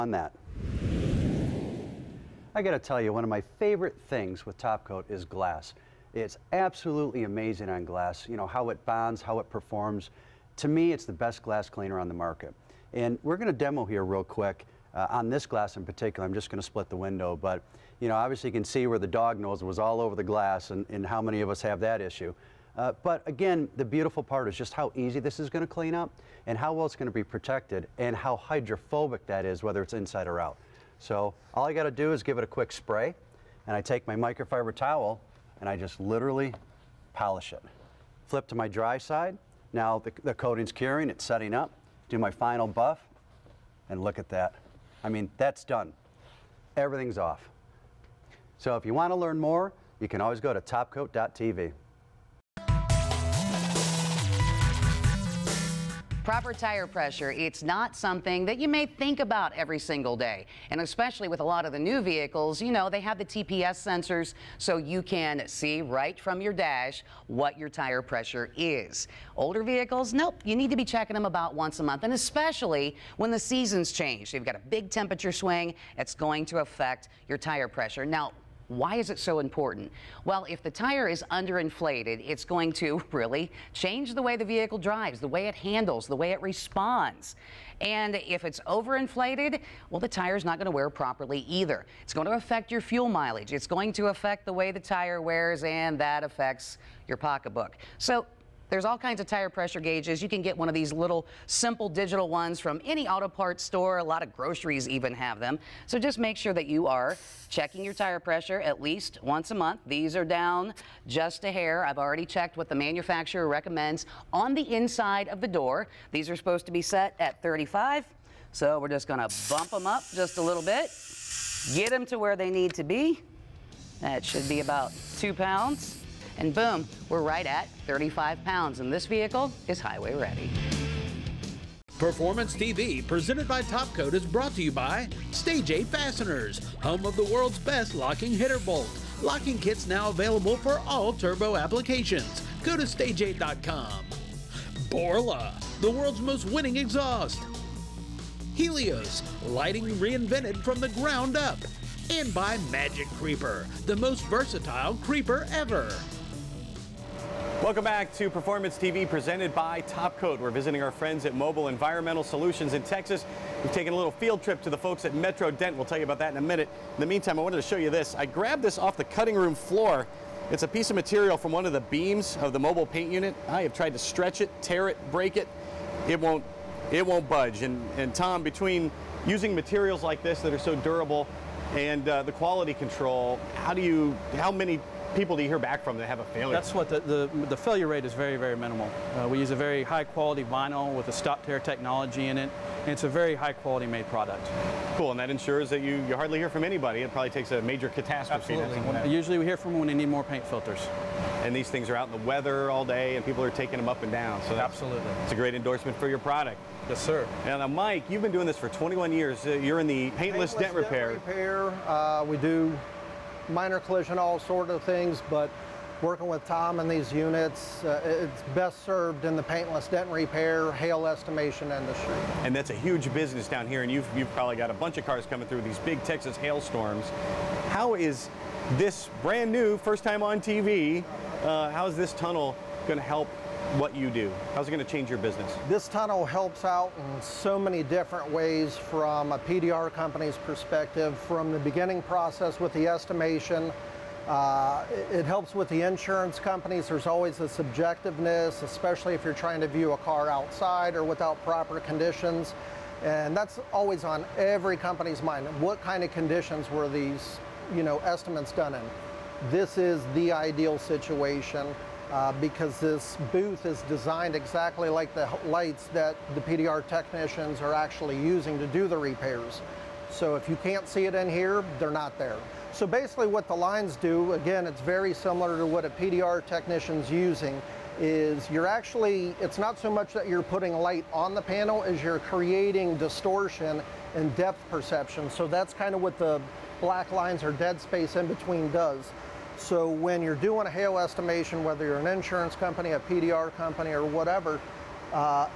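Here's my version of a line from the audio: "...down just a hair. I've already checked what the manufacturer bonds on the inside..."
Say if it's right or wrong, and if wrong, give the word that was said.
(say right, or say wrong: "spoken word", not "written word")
wrong: "recommends", not "bonds".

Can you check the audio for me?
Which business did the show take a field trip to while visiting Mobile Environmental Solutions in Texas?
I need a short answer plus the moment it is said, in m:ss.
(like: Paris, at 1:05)
Metro Dent, at 2:45.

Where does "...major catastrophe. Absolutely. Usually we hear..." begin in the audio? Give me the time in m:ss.
3:17.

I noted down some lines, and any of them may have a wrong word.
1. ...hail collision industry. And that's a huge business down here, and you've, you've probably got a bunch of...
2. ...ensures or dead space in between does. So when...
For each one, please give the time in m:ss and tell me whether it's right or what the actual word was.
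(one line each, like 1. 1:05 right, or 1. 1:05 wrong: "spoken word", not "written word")
1. 3:40 wrong: "estimation", not "collision"
2. 4:47 wrong: "lines", not "ensures".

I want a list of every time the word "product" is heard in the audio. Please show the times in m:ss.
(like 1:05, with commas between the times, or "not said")
3:14, 3:26.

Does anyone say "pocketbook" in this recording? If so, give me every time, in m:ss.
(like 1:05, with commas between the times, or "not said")
1:37.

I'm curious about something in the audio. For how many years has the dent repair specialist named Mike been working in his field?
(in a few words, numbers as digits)
21.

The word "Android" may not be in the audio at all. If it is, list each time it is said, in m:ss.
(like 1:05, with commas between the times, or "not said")
not said.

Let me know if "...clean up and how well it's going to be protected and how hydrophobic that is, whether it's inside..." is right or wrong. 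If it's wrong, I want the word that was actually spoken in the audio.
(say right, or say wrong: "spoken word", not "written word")
right.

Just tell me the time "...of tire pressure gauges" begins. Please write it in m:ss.
1:39.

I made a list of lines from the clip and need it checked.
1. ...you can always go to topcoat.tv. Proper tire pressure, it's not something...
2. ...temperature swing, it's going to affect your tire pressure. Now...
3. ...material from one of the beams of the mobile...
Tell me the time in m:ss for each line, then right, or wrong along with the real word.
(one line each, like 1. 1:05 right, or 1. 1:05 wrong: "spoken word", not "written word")
1. 0:50 right
2. 1:14 right
3. 2:50 right.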